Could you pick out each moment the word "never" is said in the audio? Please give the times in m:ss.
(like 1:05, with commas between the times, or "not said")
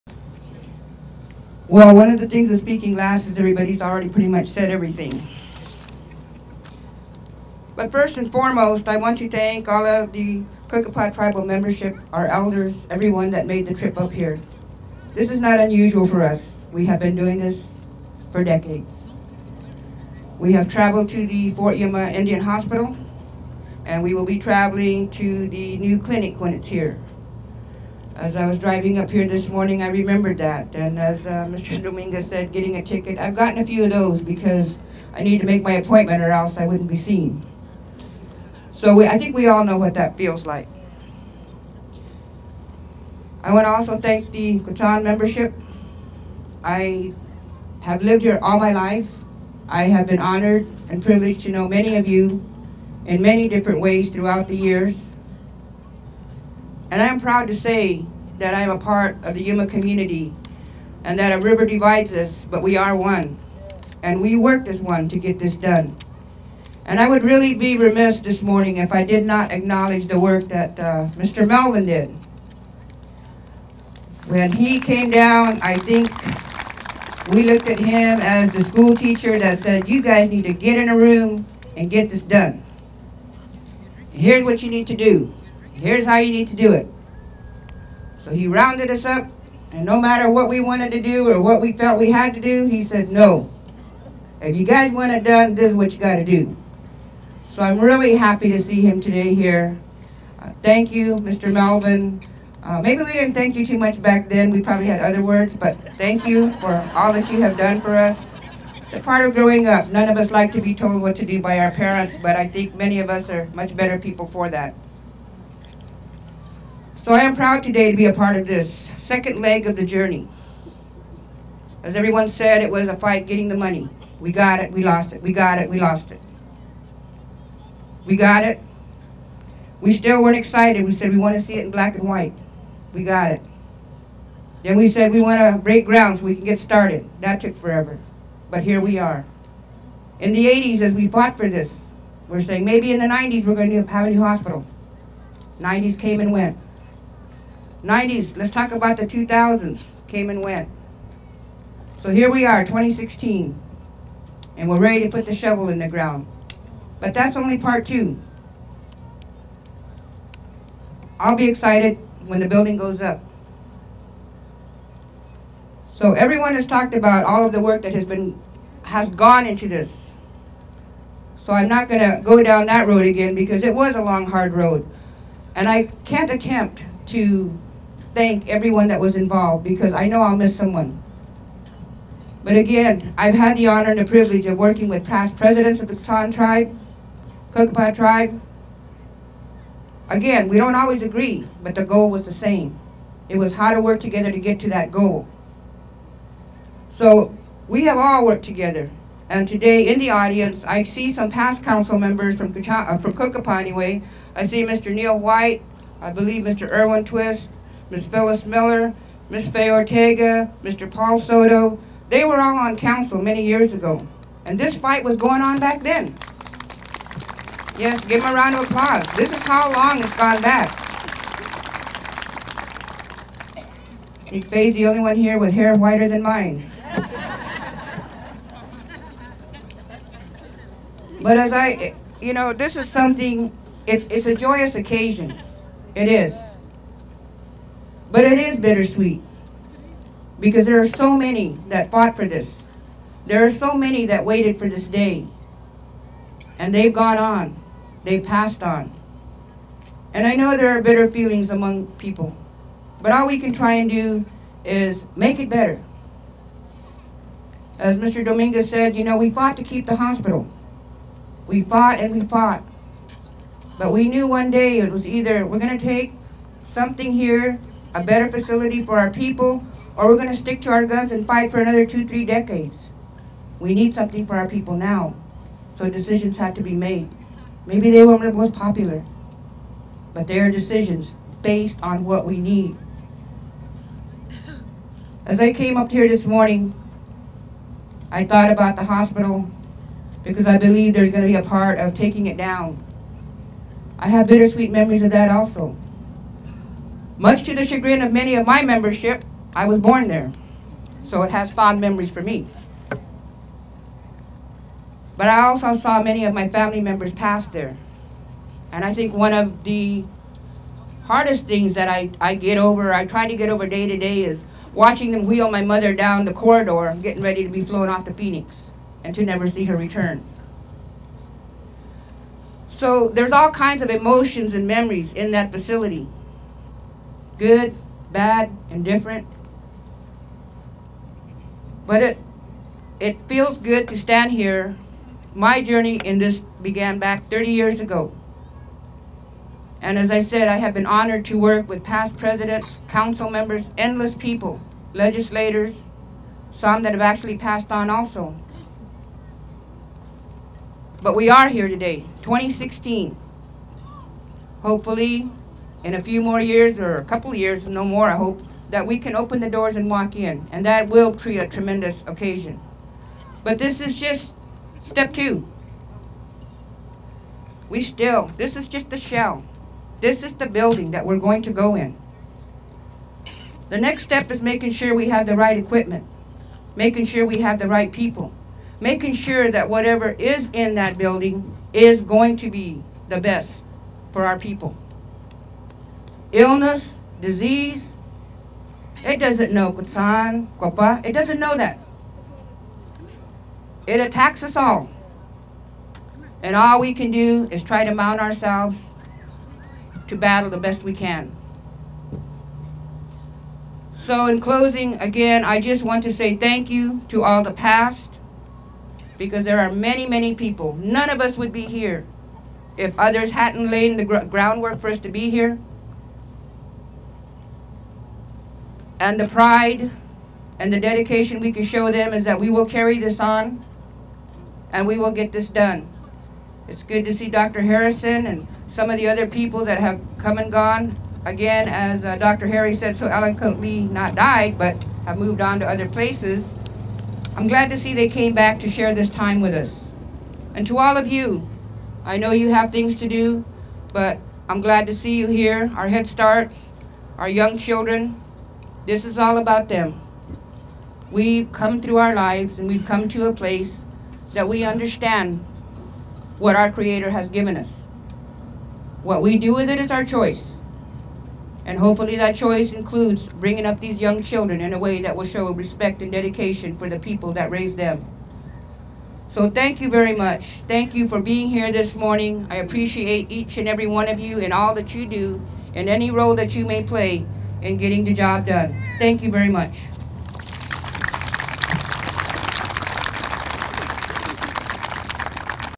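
5:19.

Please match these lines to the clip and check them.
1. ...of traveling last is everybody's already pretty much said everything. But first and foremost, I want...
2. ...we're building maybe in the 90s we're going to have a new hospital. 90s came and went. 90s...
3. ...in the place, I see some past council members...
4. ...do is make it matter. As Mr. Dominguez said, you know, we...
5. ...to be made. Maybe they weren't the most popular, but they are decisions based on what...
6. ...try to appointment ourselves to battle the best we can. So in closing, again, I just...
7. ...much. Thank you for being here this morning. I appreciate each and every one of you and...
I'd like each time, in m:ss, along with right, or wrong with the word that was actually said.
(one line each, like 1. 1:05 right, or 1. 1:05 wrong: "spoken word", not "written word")
1. 0:02 wrong: "speaking", not "traveling"
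2. 2:22 wrong: "saying", not "building"
3. 3:19 wrong: "audience", not "place"
4. 4:13 wrong: "better", not "matter"
5. 4:36 right
6. 6:37 wrong: "mount", not "appointment"
7. 7:50 right.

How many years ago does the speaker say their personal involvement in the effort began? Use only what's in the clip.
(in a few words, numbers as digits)
30.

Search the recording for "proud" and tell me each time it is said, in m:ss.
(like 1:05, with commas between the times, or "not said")
0:57, 1:57.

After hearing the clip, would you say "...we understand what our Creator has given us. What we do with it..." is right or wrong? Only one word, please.
right.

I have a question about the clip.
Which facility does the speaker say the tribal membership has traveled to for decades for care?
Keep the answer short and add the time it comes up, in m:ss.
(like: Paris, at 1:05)
Fort Yuma Indian Hospital, at 0:21.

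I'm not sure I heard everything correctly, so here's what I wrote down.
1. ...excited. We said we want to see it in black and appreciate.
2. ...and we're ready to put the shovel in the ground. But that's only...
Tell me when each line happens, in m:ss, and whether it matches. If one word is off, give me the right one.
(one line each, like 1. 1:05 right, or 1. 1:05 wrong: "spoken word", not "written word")
1. 2:10 wrong: "white", not "appreciate"
2. 2:34 right.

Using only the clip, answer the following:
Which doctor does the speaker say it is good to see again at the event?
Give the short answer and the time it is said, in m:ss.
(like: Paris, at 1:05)
Dr. Harrison, at 7:07.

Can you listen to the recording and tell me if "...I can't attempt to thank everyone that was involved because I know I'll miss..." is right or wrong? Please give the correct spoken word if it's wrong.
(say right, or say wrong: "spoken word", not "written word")
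right.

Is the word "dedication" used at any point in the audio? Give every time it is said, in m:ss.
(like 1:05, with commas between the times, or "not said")
7:00, 7:46.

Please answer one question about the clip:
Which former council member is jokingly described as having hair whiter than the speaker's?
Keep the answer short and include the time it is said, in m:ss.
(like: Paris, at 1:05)
Fay, at 3:44.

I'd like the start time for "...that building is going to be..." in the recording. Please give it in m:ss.
6:20.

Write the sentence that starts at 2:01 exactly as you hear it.
As everyone said, it was a fight getting the money.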